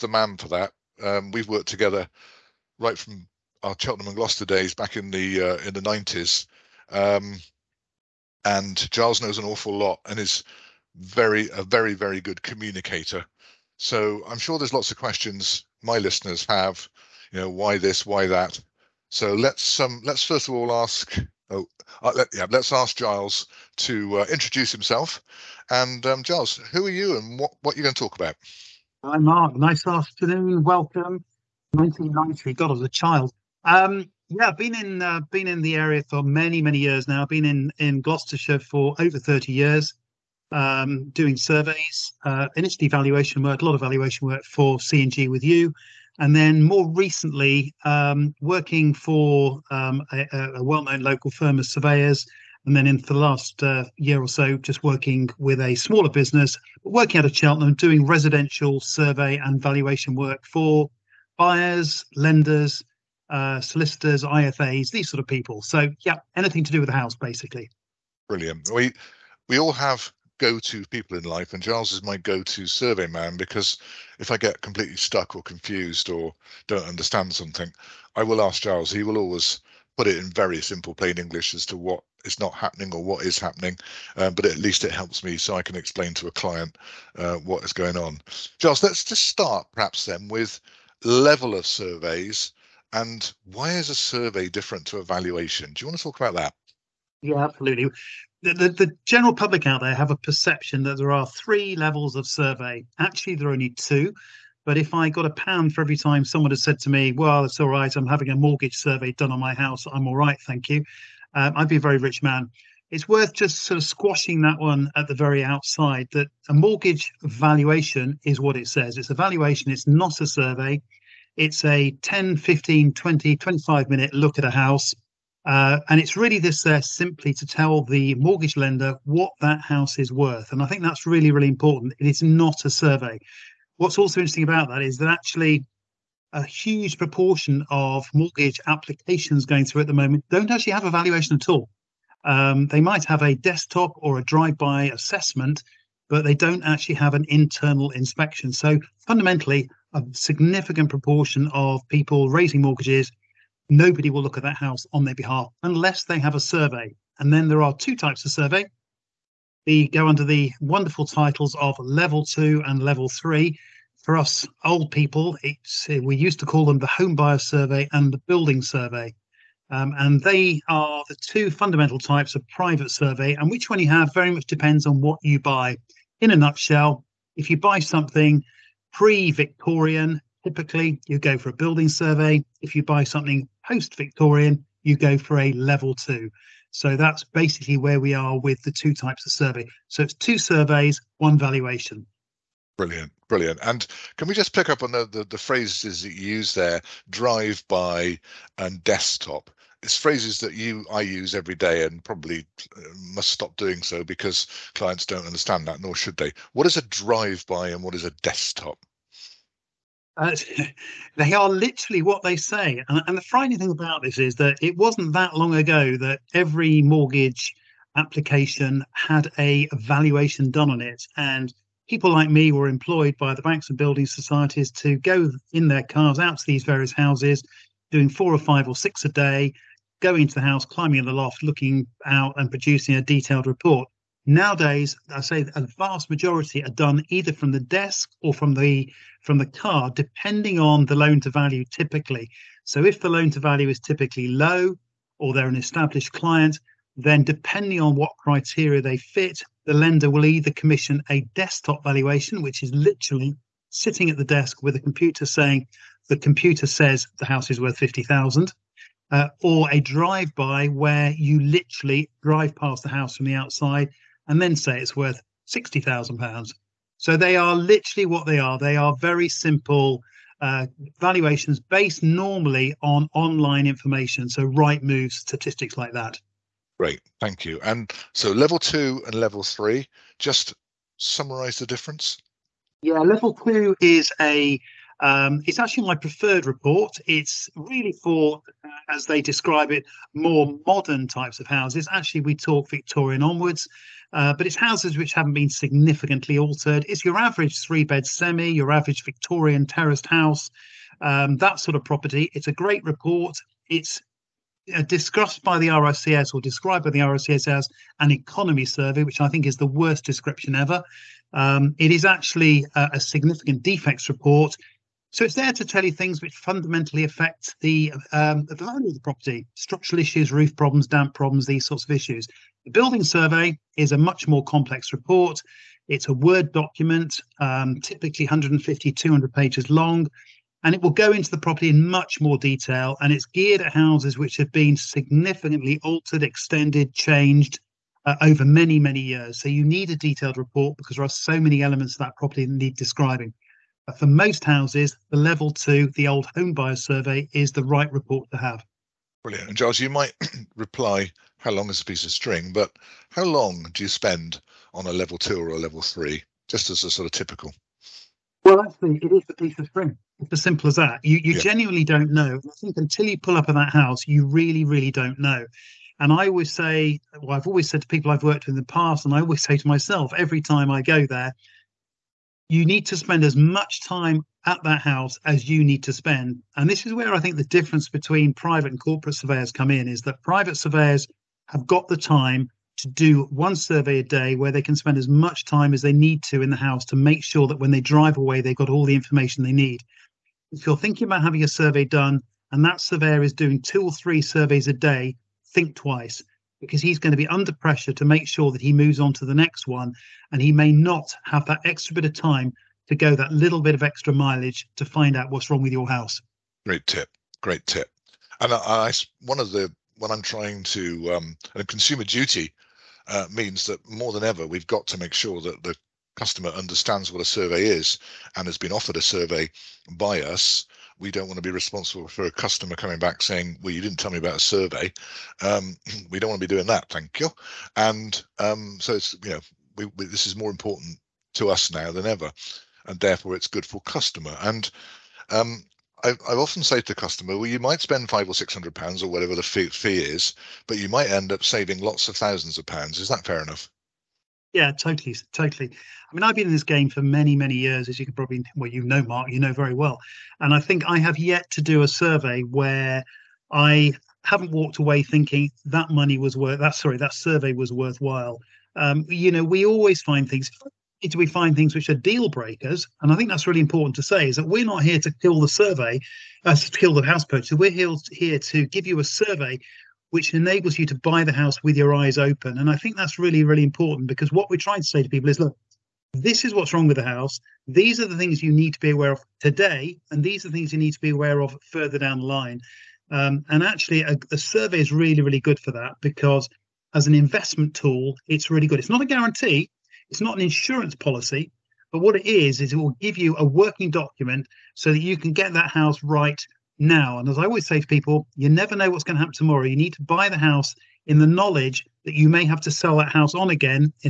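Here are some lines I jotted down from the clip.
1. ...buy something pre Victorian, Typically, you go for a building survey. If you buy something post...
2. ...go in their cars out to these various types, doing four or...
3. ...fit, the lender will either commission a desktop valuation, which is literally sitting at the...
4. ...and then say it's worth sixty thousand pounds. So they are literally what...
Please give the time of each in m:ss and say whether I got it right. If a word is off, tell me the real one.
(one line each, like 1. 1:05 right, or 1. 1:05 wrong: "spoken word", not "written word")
1. 2:57 right
2. 3:44 wrong: "houses", not "types"
3. 4:08 right
4. 4:24 right.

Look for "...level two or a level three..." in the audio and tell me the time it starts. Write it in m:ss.
5:54.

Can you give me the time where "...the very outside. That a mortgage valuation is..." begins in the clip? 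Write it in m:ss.
1:55.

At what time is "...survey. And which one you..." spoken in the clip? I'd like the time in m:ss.
2:52.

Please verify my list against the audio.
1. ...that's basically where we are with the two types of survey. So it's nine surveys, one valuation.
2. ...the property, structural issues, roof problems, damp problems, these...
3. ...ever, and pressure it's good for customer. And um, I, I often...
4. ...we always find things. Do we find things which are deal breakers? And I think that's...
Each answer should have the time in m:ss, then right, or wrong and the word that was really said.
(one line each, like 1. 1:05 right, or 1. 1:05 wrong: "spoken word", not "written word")
1. 3:06 wrong: "two", not "nine"
2. 5:18 right
3. 7:12 wrong: "therefore", not "pressure"
4. 7:39 right.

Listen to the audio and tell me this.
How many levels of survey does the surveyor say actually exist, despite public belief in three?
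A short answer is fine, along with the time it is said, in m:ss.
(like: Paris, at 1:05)
2, at 1:43.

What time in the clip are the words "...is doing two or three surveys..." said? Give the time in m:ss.
6:33.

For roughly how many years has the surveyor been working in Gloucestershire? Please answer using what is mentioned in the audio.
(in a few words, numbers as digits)
over 30 years.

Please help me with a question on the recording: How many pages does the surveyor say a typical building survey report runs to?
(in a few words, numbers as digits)
150 to 200 pages.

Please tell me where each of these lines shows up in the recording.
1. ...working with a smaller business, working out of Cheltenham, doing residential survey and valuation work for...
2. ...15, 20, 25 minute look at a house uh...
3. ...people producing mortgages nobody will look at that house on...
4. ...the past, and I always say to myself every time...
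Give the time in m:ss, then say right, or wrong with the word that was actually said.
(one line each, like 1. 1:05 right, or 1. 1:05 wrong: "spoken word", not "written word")
1. 0:54 right
2. 2:02 right
3. 2:31 wrong: "raising", not "producing"
4. 6:08 right.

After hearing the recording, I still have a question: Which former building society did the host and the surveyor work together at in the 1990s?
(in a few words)
Cheltenham and Gloucester.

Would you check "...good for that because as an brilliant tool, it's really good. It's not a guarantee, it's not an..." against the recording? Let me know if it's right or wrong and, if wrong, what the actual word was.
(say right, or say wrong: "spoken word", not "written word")
wrong: "investment", not "brilliant".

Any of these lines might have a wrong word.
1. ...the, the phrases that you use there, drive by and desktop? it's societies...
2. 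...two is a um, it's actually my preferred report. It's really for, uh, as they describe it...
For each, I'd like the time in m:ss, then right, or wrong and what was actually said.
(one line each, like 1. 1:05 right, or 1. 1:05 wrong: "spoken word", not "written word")
1. 3:15 wrong: "phrases", not "societies"
2. 4:43 right.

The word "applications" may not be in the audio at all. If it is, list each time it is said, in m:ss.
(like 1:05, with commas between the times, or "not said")
2:18, 3:37.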